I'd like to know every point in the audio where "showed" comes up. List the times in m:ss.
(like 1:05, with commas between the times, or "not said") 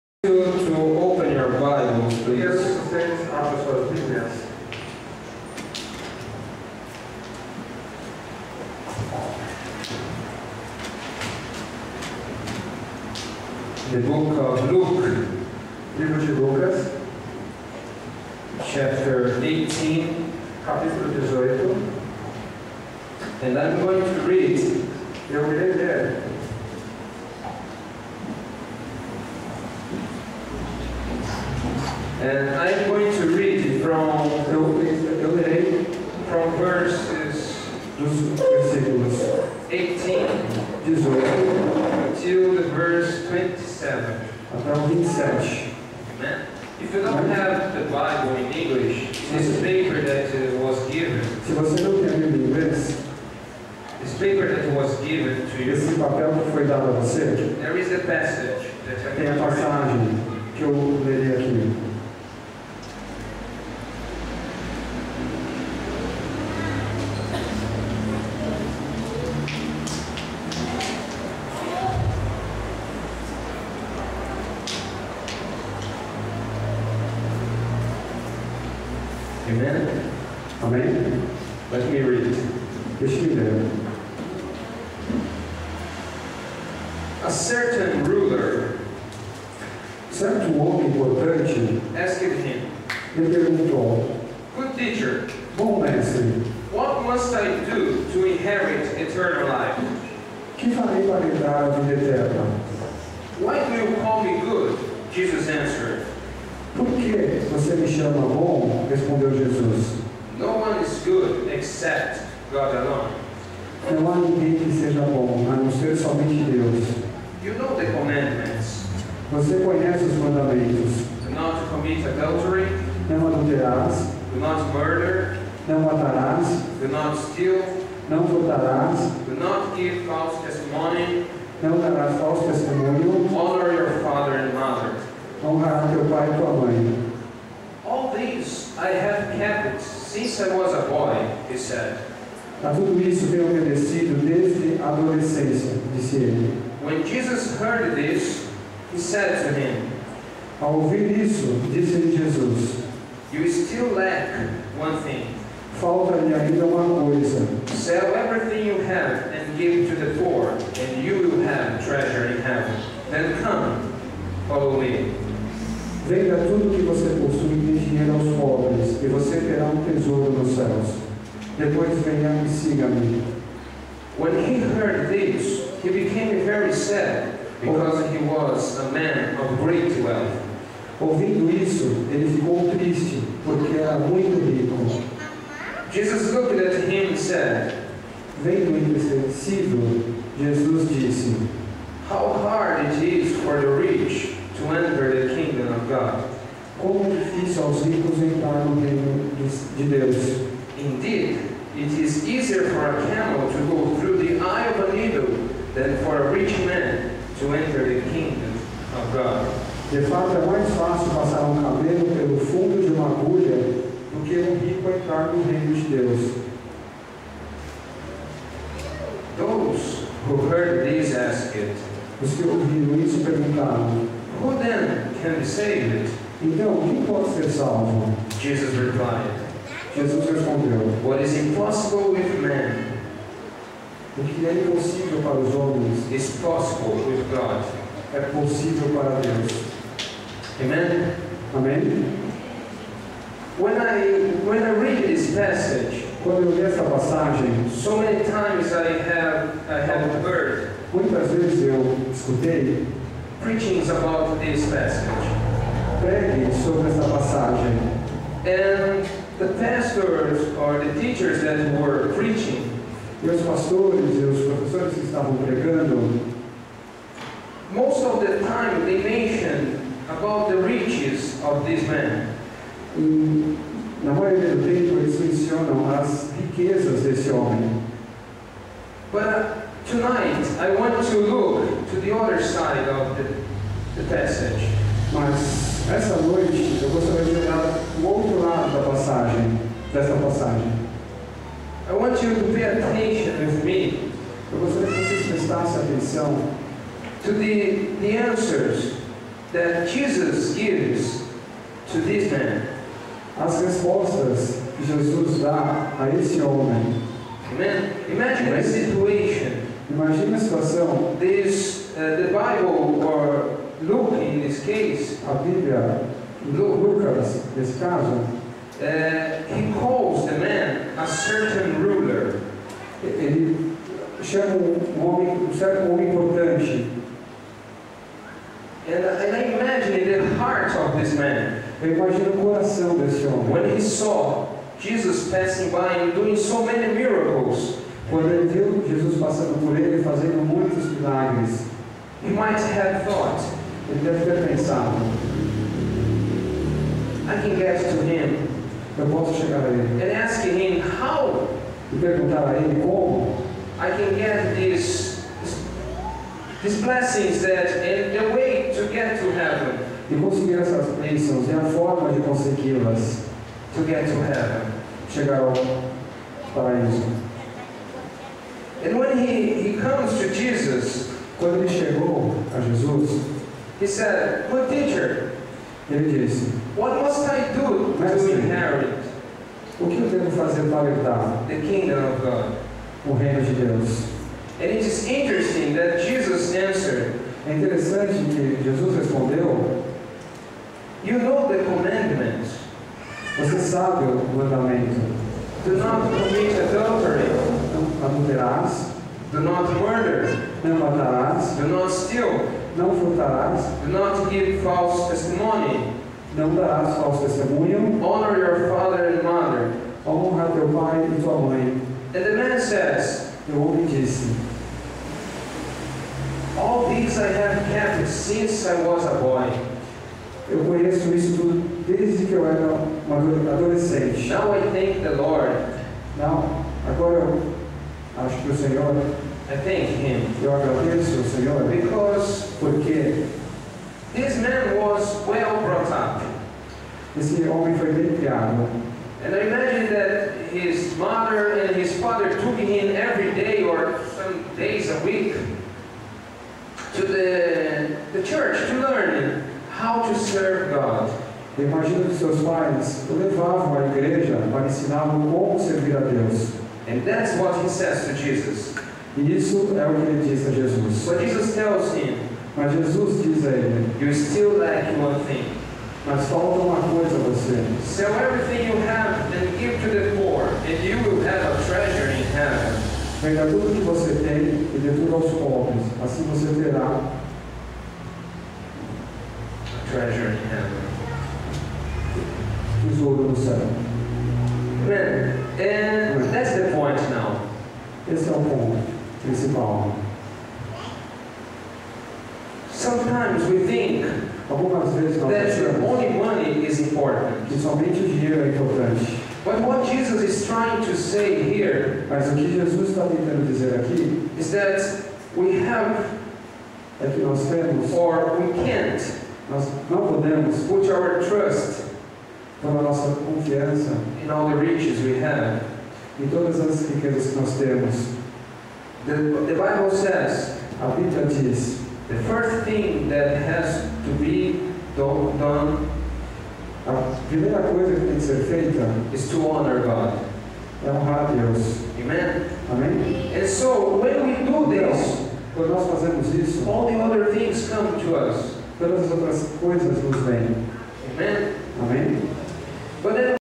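not said.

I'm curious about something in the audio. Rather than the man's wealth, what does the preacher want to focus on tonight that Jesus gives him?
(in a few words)
The answers.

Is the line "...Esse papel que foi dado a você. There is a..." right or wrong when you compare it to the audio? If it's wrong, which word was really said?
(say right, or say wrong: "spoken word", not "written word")
right.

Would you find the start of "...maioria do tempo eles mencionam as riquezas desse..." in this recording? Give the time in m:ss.
4:34.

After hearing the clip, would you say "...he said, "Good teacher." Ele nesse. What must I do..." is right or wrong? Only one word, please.
wrong.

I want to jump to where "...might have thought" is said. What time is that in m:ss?
5:42.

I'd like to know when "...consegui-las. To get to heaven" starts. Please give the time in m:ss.
6:02.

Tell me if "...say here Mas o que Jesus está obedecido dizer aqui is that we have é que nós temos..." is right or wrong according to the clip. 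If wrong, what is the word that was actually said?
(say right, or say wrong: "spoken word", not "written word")
wrong: "tentando", not "obedecido".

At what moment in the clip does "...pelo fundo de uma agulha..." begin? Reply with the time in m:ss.
3:32.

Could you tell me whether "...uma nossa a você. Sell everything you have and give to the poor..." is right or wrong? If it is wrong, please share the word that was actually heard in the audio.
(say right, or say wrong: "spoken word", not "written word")
wrong: "coisa", not "nossa".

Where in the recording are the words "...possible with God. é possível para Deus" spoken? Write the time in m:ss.
3:56.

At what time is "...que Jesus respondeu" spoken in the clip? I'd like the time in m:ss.
6:28.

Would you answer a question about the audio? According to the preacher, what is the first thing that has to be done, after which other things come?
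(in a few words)
Honor God.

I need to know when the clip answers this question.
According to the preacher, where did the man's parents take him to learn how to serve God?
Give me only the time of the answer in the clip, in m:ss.
7:28.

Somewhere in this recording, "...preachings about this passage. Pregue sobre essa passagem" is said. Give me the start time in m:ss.
4:13.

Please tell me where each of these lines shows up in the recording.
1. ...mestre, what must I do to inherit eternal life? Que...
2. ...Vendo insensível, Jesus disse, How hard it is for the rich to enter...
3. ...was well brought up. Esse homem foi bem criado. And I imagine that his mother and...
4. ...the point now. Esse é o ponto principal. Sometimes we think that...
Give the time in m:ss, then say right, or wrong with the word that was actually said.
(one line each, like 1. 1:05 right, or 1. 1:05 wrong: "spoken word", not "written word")
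1. 1:35 right
2. 3:08 right
3. 7:14 right
4. 8:06 right.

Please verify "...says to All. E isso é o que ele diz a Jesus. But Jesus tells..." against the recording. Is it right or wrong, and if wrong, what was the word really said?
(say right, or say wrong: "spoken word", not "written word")
wrong: "Jesus", not "All".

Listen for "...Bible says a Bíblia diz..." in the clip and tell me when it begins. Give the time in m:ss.
8:39.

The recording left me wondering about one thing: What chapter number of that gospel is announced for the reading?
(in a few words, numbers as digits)
18.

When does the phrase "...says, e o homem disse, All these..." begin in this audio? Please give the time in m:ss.
6:52.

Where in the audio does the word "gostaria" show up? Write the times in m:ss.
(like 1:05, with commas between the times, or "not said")
4:46.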